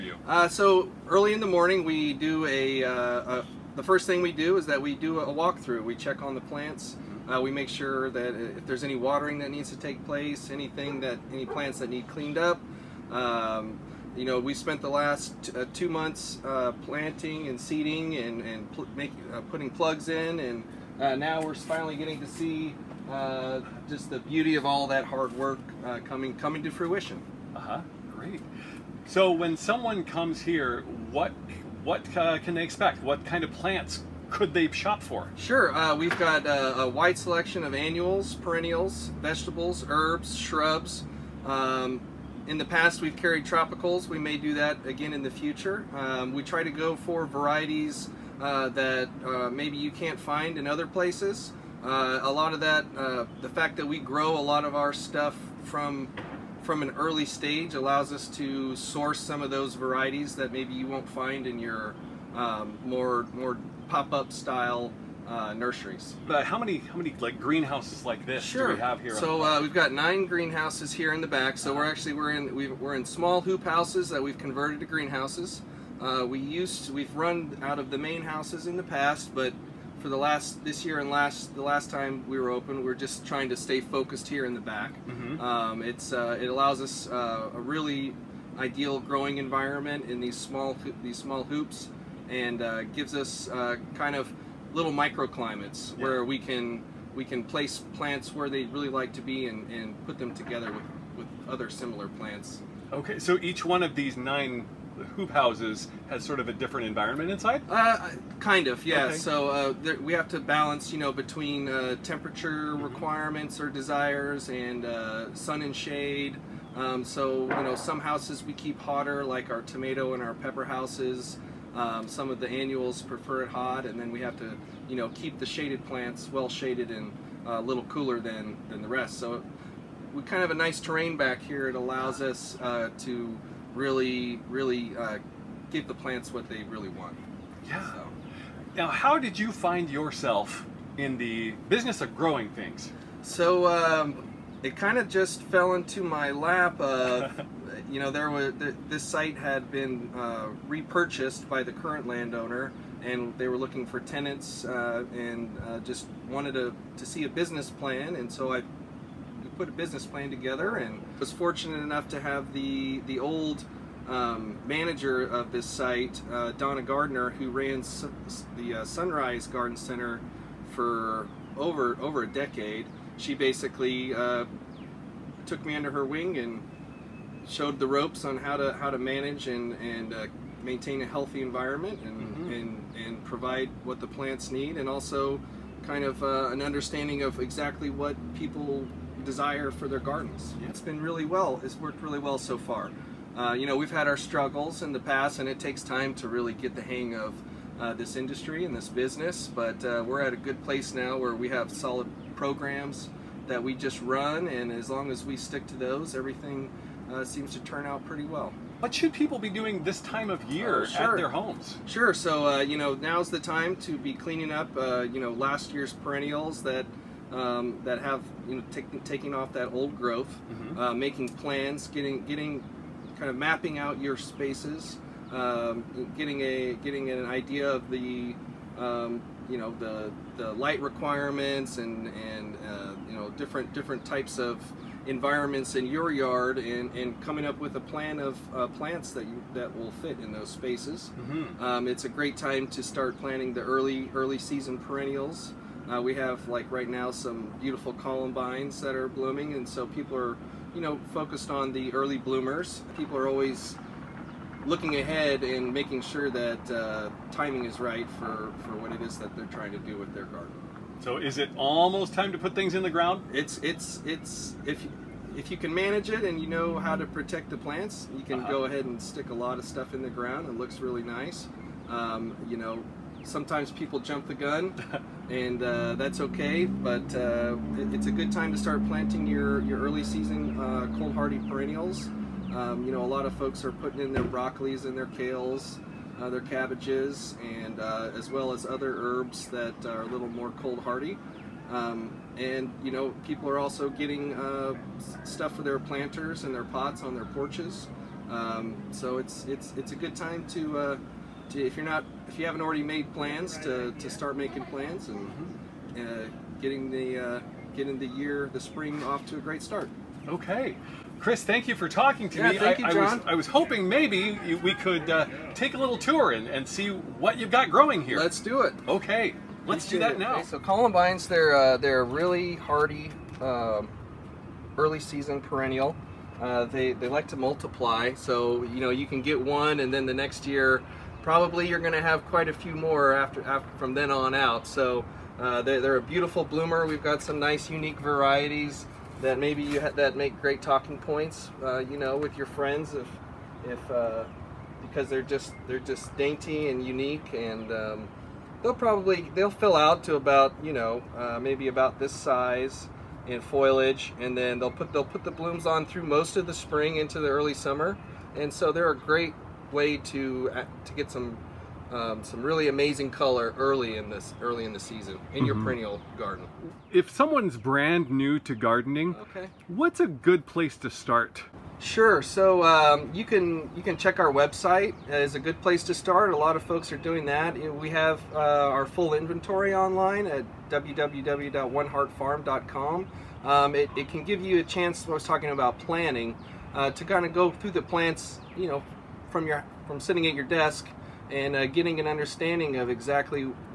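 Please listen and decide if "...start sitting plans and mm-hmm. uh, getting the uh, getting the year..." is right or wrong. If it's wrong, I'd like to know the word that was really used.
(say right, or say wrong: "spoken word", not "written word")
wrong: "making", not "sitting".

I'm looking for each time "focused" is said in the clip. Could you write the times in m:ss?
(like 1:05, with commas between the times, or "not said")
1:23, 4:11.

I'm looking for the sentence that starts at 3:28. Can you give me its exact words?
What should people be doing this time of year uh, sure.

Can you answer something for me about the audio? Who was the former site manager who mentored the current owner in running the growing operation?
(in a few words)
Donna Gardner.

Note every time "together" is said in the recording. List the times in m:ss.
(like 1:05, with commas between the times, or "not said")
1:40, 2:40.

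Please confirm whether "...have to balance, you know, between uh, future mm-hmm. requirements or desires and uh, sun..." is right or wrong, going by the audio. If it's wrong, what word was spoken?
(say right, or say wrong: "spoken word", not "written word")
wrong: "temperature", not "future".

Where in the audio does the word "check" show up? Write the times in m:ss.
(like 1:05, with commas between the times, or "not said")
0:05, 6:13.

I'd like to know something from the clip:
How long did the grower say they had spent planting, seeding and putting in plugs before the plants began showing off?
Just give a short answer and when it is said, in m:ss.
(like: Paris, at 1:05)
Two months, at 0:15.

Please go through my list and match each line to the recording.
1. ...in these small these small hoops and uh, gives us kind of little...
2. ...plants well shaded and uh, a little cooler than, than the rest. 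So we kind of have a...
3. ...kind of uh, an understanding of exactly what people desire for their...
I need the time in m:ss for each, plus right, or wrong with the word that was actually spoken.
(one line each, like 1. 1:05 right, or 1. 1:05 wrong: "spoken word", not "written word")
1. 1:30 right
2. 2:05 right
3. 3:05 right.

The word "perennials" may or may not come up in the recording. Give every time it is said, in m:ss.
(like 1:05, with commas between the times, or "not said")
0:38, 3:35, 4:04, 4:41, 5:25, 6:05.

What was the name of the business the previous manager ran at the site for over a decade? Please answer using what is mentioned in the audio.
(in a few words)
Sunrise Garden Center.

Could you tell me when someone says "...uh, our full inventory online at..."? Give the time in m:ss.
6:18.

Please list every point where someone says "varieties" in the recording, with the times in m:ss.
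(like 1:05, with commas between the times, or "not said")
0:47, 0:59, 5:37.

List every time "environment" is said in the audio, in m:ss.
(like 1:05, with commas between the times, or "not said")
1:29, 1:46, 3:01, 3:55.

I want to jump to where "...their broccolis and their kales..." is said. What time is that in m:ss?
4:44.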